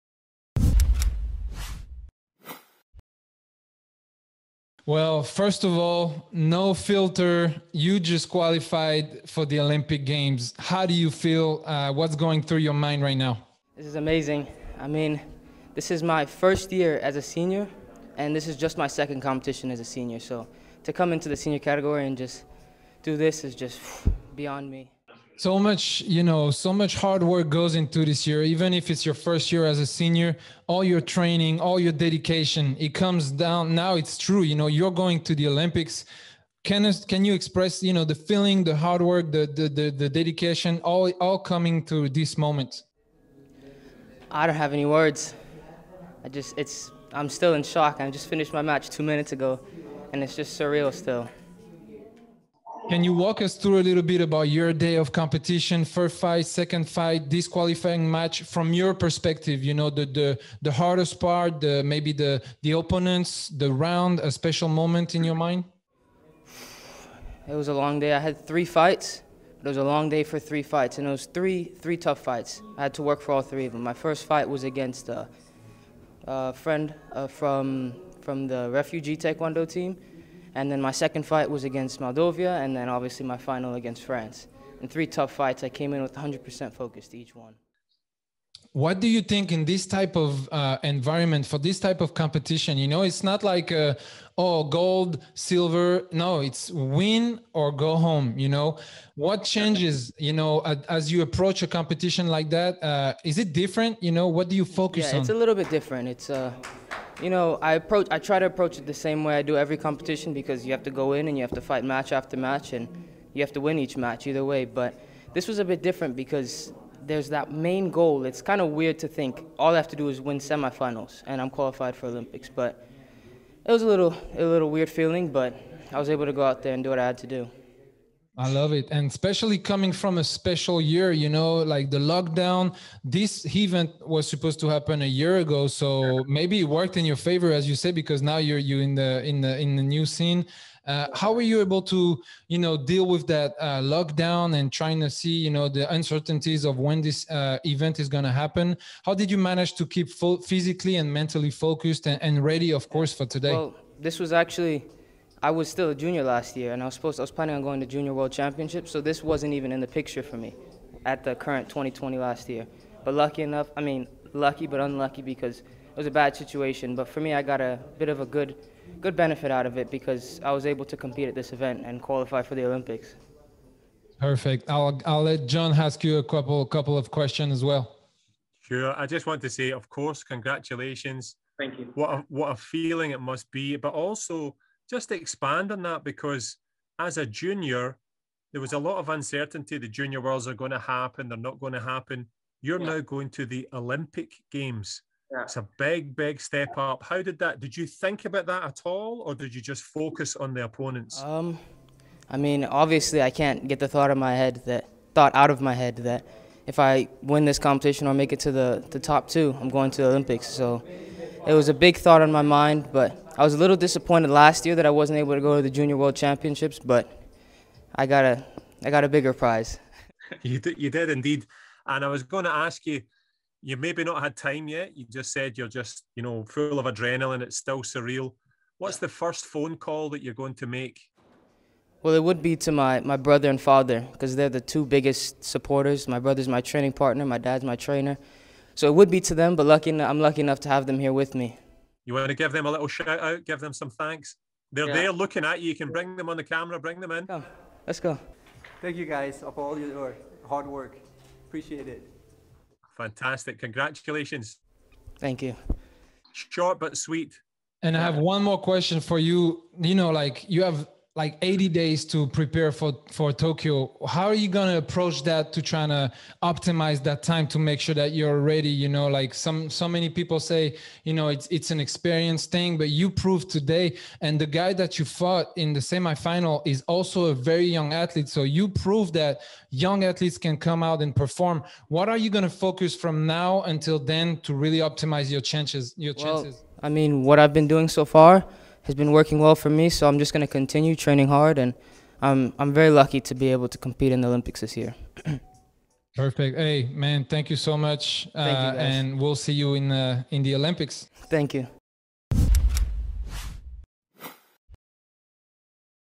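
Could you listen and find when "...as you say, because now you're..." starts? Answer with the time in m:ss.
2:17.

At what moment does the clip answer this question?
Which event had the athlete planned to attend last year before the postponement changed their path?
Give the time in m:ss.
2:37.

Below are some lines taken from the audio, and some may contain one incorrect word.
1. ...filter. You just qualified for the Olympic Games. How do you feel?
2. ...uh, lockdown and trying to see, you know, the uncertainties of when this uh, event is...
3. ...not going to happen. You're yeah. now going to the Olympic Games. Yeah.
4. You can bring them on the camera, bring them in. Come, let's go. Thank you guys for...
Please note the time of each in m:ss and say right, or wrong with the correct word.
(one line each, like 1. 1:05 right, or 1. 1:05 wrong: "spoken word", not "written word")
1. 0:06 right
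2. 2:23 right
3. 3:11 right
4. 4:05 right.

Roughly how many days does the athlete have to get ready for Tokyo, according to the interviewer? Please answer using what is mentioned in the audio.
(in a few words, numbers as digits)
80.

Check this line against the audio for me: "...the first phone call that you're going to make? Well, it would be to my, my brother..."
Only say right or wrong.
right.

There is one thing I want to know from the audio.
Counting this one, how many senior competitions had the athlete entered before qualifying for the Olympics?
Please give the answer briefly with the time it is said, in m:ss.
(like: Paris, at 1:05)
2, at 0:18.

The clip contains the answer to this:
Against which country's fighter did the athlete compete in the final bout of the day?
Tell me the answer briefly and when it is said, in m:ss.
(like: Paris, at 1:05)
France, at 1:24.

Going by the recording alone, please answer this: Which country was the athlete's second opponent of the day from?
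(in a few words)
Moldova.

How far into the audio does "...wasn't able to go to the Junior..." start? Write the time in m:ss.
3:34.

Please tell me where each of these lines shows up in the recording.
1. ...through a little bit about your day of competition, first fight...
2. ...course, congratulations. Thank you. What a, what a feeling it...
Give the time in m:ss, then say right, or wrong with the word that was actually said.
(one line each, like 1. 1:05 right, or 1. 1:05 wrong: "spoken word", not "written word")
1. 0:53 right
2. 2:59 right.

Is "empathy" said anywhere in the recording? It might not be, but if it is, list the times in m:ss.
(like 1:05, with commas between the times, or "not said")
not said.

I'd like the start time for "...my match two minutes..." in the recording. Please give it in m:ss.
0:48.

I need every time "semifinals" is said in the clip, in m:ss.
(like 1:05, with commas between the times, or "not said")
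2:00, 4:35.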